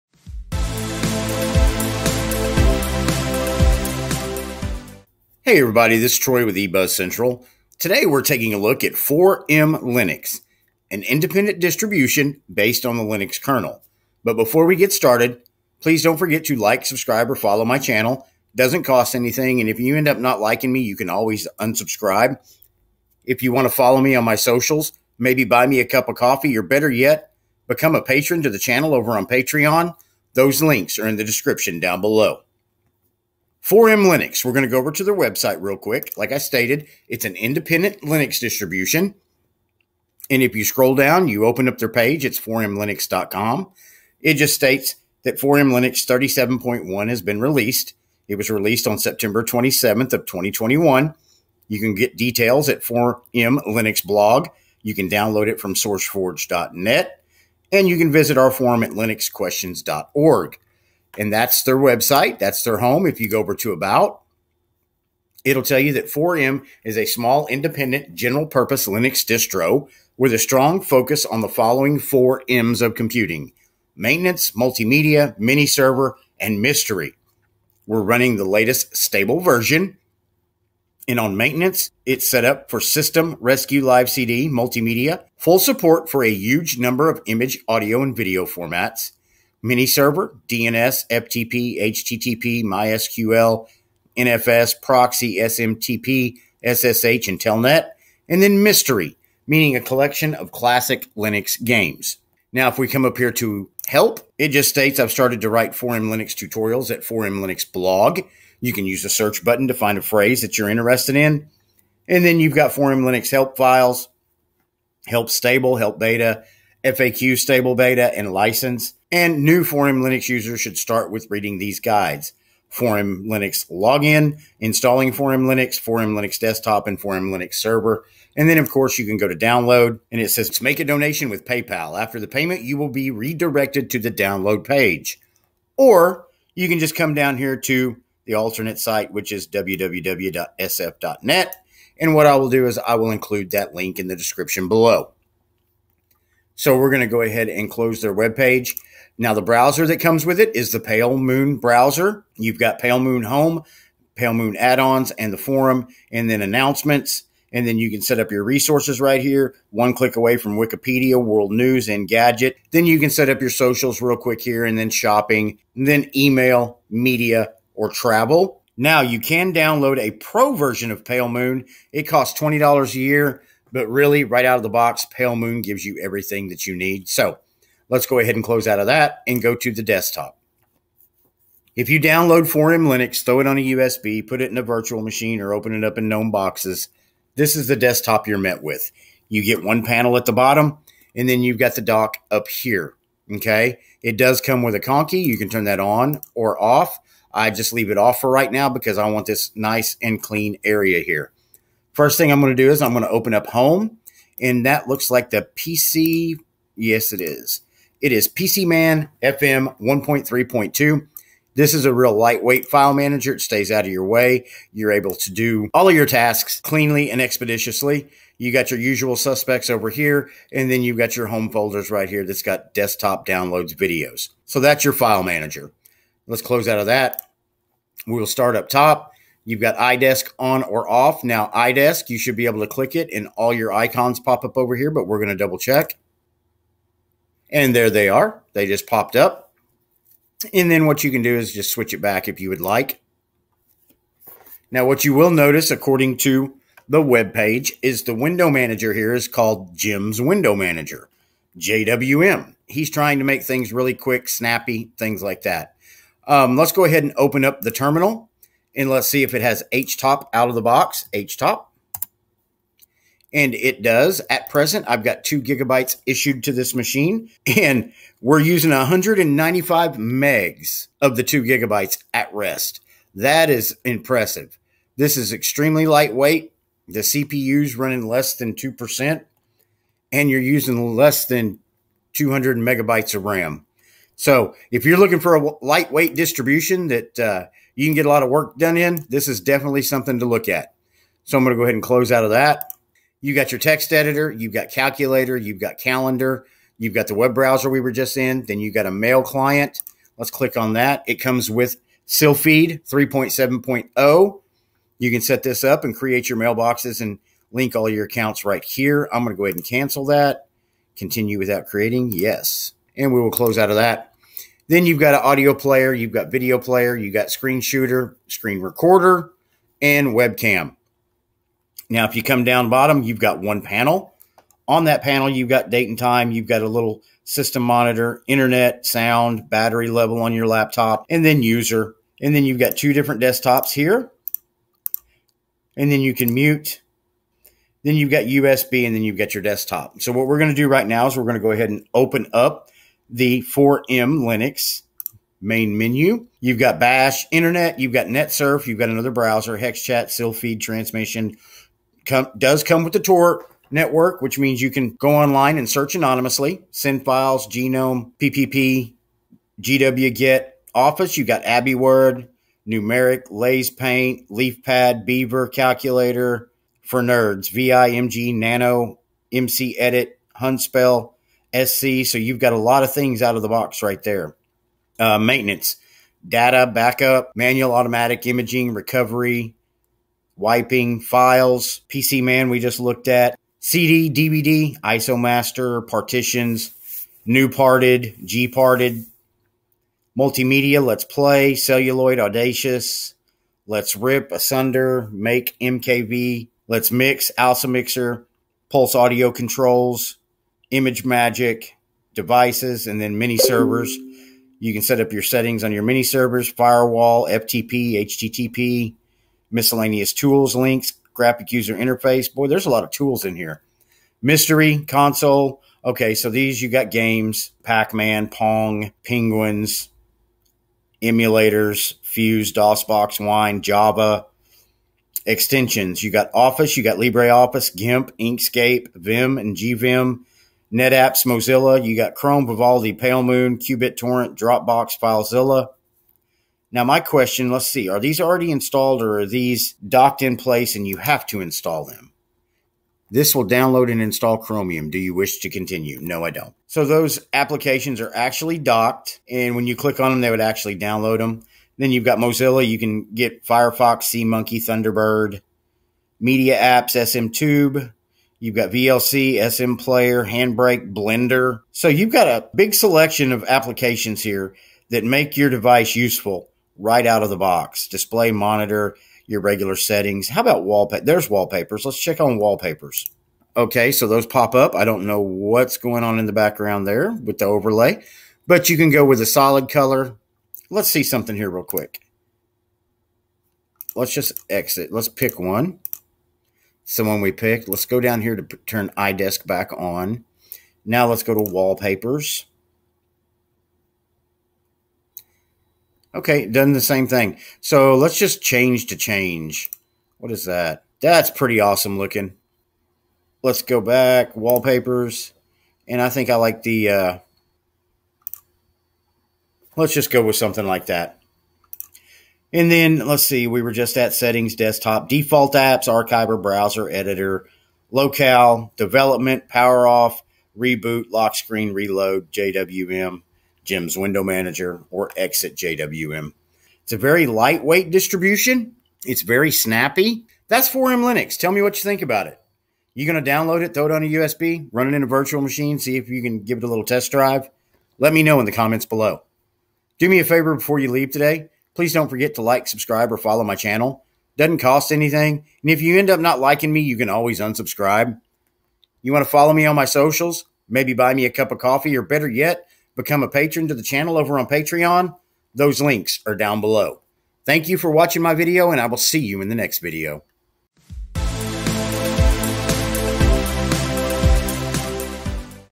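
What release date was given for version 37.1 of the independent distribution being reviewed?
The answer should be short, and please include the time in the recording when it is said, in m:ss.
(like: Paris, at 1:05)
September 27th, 2021, at 0:48.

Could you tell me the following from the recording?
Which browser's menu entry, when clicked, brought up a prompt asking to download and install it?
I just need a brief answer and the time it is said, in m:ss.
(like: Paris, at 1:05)
Chromium, at 7:24.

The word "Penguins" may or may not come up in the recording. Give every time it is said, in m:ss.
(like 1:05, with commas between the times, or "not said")
6:59.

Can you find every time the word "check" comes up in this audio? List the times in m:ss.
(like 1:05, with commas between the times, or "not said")
3:55, 7:51.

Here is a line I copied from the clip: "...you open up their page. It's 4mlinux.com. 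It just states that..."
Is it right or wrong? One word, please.
right.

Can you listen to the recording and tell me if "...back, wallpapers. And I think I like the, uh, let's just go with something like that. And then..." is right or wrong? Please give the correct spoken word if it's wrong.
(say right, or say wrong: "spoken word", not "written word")
right.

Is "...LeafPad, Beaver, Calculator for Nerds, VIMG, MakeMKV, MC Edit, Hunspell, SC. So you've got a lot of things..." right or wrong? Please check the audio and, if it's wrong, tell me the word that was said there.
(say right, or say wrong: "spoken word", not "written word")
wrong: "Nano", not "MakeMKV".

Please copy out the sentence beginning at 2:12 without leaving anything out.
After the payment, you will be redirected to the download page.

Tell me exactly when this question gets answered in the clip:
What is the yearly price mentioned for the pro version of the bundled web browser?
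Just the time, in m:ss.
2:52.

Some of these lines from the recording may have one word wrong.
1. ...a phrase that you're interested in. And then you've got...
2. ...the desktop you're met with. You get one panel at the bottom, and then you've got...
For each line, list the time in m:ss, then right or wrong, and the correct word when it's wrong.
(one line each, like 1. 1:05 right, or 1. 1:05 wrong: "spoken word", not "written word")
1. 1:49 right
2. 3:07 right.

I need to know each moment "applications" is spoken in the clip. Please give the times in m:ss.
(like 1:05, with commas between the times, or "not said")
7:27, 7:43.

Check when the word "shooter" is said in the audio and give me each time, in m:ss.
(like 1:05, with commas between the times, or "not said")
5:17.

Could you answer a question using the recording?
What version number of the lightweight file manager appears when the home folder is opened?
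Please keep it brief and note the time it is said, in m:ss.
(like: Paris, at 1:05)
1.3.2, at 3:29.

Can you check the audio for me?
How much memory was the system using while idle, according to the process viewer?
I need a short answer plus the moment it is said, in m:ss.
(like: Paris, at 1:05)
195 megs, at 4:28.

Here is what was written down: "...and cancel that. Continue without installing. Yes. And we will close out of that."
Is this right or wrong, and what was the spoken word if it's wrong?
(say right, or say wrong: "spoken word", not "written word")
wrong: "creating", not "installing".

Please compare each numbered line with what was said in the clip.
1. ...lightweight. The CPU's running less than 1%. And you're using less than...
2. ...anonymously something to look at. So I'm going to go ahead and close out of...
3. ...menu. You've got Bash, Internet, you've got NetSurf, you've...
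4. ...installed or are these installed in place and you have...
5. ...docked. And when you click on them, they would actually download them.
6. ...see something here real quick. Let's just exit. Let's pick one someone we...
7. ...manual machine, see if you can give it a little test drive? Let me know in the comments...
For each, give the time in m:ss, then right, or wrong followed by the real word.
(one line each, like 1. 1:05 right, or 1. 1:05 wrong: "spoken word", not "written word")
1. 4:35 wrong: "2", not "1"
2. 4:49 wrong: "definitely", not "anonymously"
3. 5:45 right
4. 7:18 wrong: "docked", not "installed"
5. 7:28 right
6. 8:00 right
7. 8:55 wrong: "virtual", not "manual".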